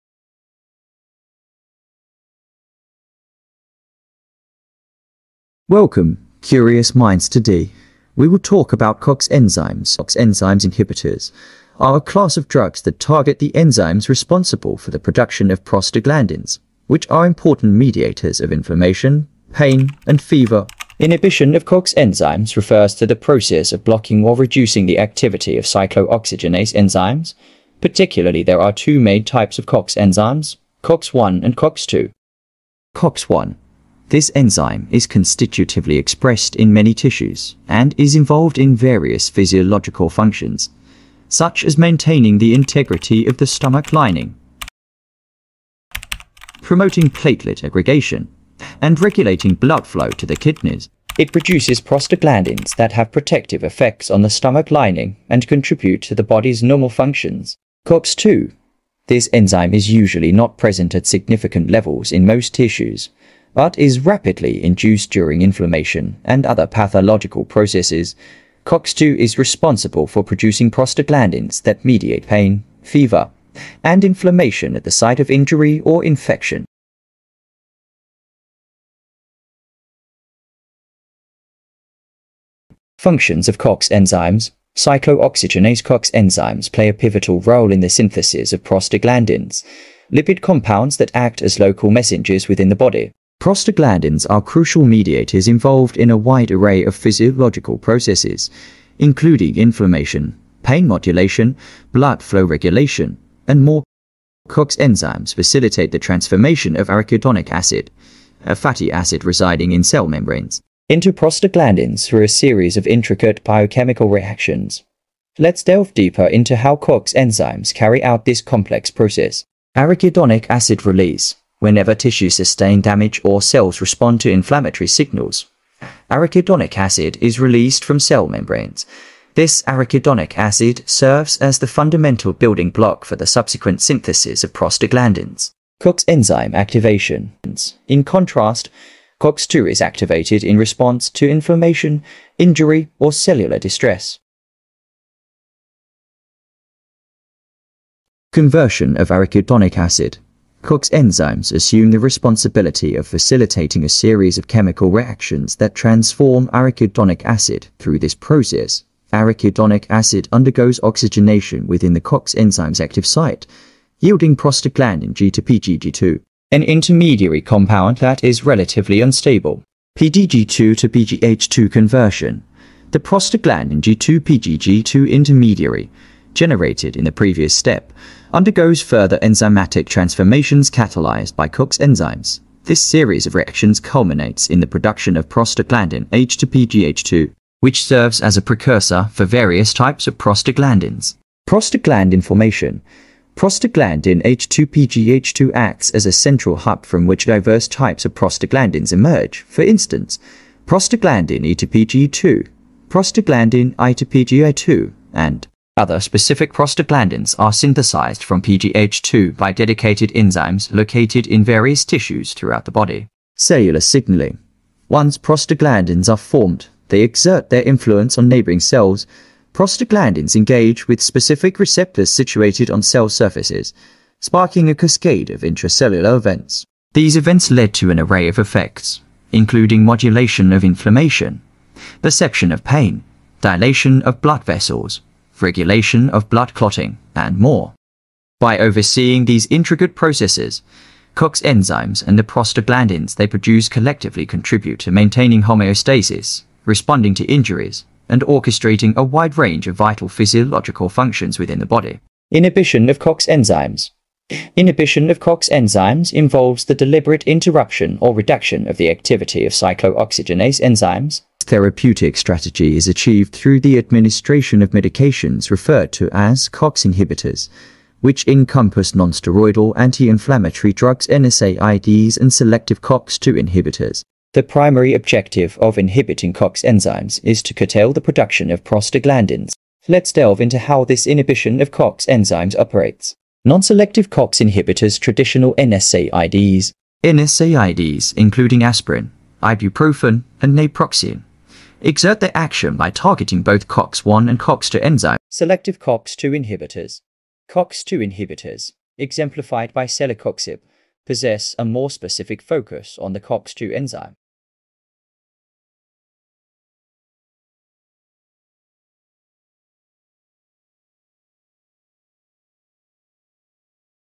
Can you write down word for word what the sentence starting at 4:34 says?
The primary objective of inhibiting COX enzymes is to curtail the production of prostaglandins.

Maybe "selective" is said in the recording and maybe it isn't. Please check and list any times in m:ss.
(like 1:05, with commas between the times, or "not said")
4:32, 4:43, 4:55.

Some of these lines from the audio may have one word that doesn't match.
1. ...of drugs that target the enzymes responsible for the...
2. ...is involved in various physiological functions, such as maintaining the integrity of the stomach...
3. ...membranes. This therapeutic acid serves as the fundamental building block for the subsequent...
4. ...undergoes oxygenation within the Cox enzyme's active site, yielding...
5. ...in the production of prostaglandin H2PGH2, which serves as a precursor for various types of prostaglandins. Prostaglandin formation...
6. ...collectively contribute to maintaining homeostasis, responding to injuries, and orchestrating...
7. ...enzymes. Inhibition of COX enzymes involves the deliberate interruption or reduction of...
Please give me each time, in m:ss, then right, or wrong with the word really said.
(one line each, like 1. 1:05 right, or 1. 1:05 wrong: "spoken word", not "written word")
1. 0:12 right
2. 0:37 right
3. 2:08 wrong: "arachidonic", not "therapeutic"
4. 2:40 right
5. 3:04 right
6. 4:03 right
7. 4:13 right.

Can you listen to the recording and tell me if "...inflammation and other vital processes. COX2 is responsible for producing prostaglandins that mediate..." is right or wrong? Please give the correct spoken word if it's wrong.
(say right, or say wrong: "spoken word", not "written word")
wrong: "pathological", not "vital".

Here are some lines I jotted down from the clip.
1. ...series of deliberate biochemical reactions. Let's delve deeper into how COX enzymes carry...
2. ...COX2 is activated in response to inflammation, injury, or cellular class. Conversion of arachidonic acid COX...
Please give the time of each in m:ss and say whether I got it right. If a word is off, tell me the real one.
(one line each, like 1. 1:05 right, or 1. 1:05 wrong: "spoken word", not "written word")
1. 1:52 wrong: "intricate", not "deliberate"
2. 2:19 wrong: "distress", not "class".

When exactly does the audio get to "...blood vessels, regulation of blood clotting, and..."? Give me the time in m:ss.
3:54.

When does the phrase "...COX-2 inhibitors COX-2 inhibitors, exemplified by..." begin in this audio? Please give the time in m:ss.
4:55.